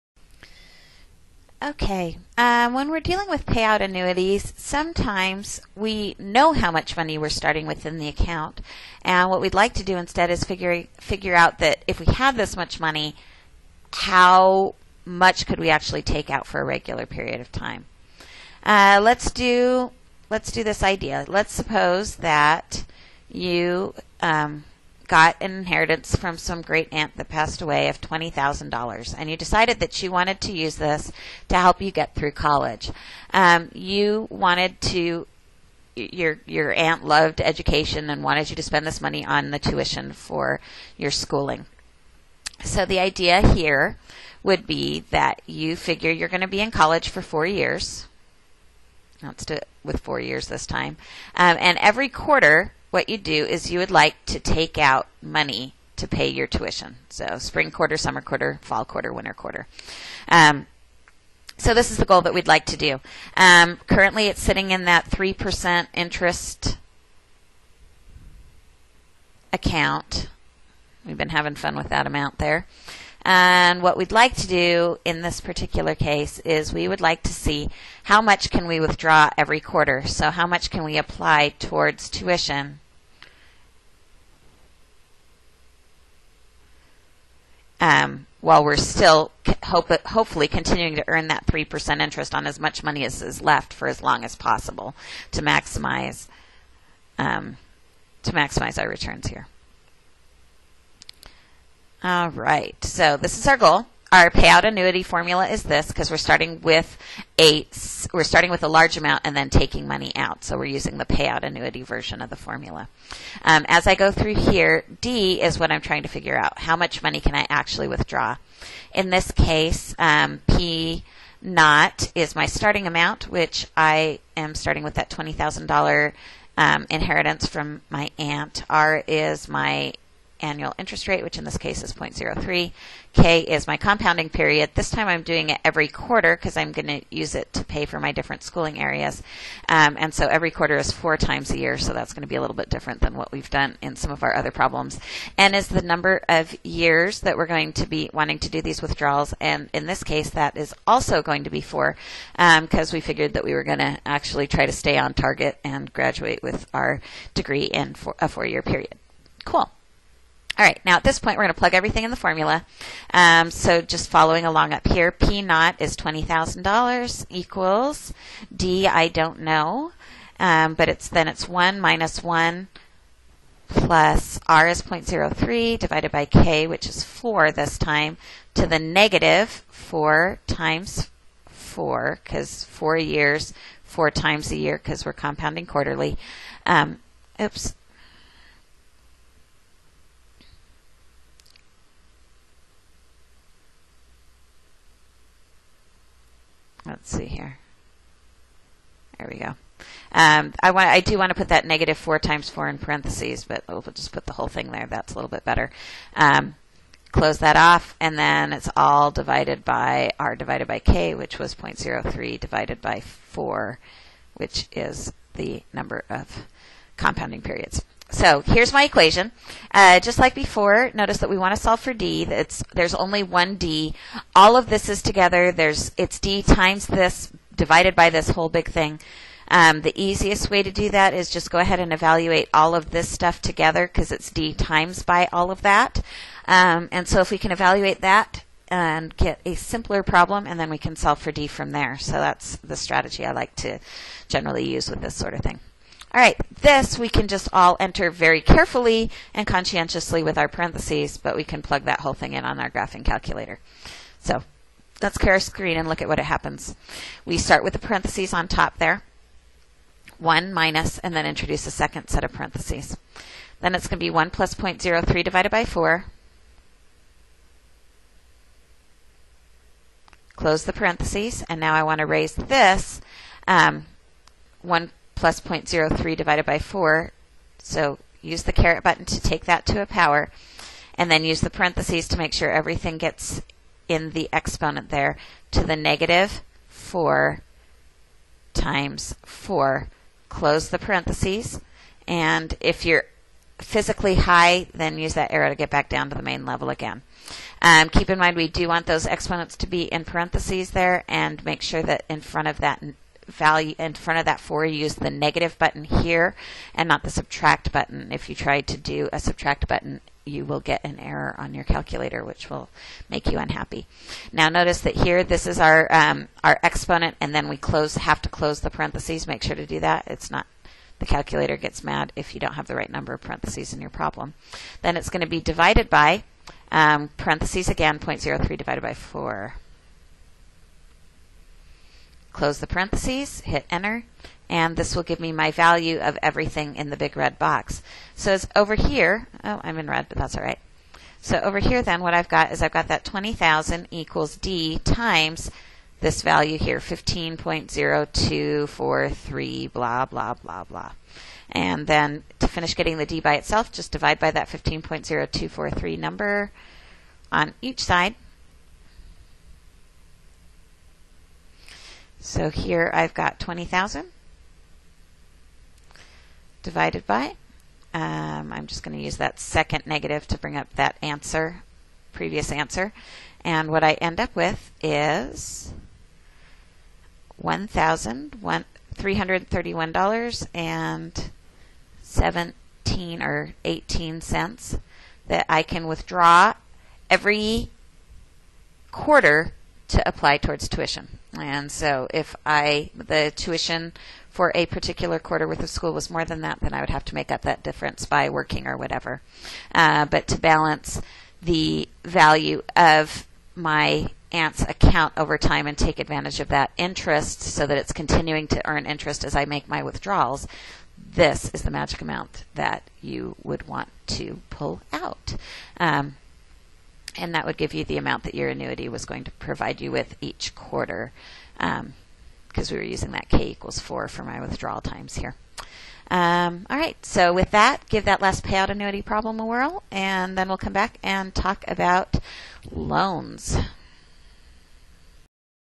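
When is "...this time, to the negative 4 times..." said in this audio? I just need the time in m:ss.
2:57.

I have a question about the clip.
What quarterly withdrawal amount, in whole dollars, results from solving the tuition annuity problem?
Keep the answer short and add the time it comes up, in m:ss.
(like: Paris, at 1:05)
$1,331, at 6:17.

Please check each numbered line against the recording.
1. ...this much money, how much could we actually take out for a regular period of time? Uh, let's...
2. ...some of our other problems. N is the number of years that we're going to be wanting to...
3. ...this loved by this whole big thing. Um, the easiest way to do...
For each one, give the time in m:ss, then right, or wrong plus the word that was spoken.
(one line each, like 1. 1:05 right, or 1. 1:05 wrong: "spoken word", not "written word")
1. 0:12 right
2. 2:23 right
3. 3:46 wrong: "divided", not "loved".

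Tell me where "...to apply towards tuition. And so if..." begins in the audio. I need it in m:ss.
6:29.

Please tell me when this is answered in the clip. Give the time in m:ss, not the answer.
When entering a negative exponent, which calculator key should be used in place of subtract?
5:05.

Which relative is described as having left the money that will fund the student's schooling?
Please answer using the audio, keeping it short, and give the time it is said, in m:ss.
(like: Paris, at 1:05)
great aunt, at 0:26.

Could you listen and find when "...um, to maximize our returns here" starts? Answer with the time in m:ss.
1:37.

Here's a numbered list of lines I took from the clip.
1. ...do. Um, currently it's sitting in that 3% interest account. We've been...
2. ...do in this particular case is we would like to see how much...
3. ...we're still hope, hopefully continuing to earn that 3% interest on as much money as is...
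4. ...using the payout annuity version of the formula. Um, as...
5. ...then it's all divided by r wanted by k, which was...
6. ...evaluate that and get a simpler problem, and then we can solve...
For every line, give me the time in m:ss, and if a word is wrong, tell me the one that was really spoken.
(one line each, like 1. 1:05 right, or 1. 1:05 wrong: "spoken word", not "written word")
1. 1:02 right
2. 1:14 right
3. 1:28 right
4. 1:50 right
5. 3:28 wrong: "divided", not "wanted"
6. 3:57 right.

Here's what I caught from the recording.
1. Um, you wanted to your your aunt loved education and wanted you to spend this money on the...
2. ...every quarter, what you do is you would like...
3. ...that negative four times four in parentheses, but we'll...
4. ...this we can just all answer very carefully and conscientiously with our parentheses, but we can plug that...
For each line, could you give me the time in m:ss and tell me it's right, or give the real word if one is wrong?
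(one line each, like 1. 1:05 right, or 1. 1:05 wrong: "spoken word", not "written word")
1. 0:33 right
2. 0:51 right
3. 3:21 right
4. 4:06 wrong: "enter", not "answer".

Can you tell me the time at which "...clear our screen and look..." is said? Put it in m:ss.
4:15.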